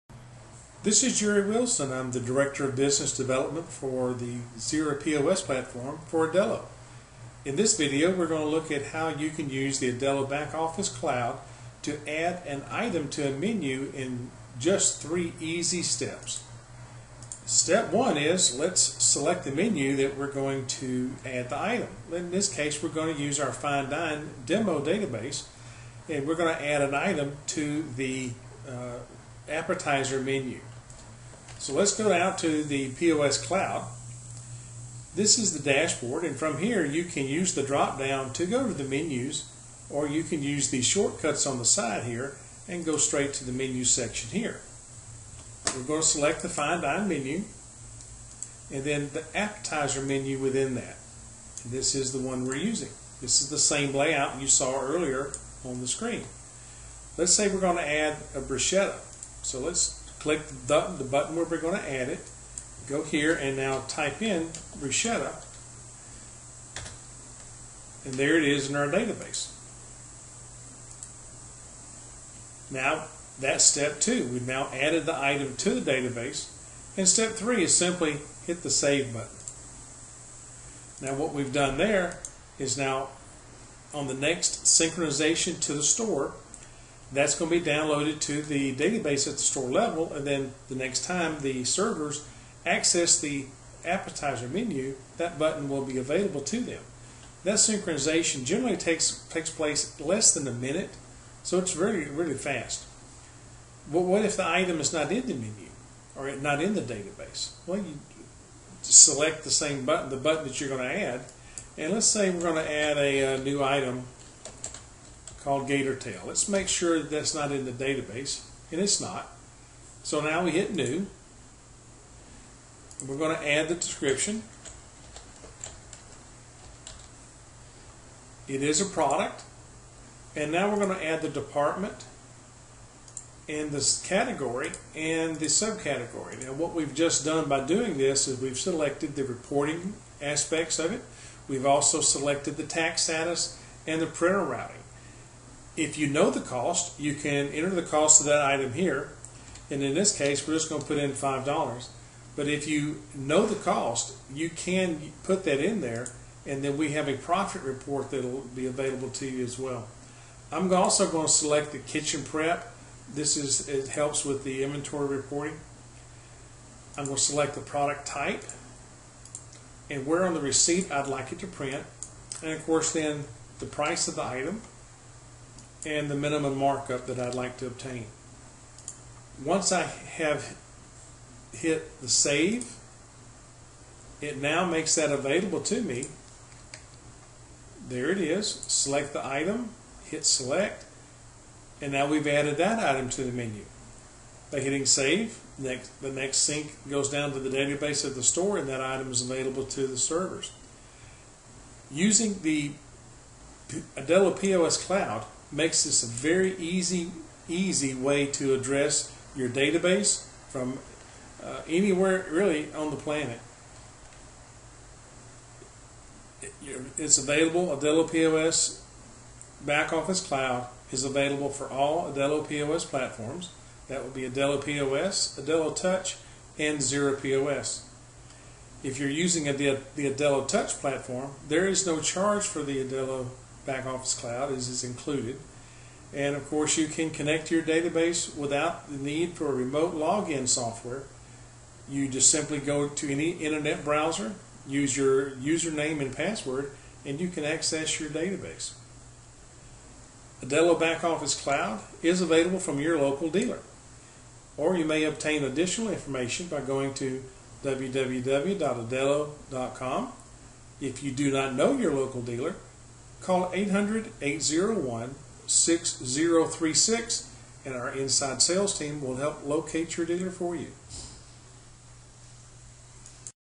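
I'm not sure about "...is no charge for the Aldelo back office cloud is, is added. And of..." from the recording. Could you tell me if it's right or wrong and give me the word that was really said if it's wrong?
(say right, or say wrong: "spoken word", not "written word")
wrong: "included", not "added".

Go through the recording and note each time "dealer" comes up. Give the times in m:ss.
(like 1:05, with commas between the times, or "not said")
4:13, 4:22, 4:30.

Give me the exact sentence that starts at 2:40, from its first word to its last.
I'm also going to select the kitchen prep.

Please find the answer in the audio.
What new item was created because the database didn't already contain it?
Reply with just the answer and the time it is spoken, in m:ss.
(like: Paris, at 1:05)
gator tail, at 1:55.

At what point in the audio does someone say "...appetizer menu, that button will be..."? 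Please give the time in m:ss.
1:33.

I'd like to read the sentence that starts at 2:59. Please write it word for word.
Once I have hit the save, it now makes that available to me.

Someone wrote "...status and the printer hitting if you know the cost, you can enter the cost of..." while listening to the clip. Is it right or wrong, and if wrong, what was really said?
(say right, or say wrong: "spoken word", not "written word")
wrong: "routing", not "hitting".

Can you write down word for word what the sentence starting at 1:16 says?
And step three is simply hit the save button.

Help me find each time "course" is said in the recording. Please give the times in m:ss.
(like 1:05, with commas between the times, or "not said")
2:52, 3:56.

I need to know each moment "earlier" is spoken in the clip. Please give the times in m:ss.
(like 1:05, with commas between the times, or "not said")
0:54.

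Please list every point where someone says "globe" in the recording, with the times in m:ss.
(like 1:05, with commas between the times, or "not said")
not said.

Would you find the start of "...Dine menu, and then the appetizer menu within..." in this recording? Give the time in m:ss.
0:46.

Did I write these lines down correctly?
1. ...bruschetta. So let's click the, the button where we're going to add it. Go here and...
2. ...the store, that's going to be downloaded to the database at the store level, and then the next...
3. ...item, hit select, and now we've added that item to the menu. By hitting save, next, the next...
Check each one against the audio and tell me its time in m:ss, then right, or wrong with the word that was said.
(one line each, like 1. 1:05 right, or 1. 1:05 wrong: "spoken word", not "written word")
1. 0:58 right
2. 1:25 right
3. 3:09 right.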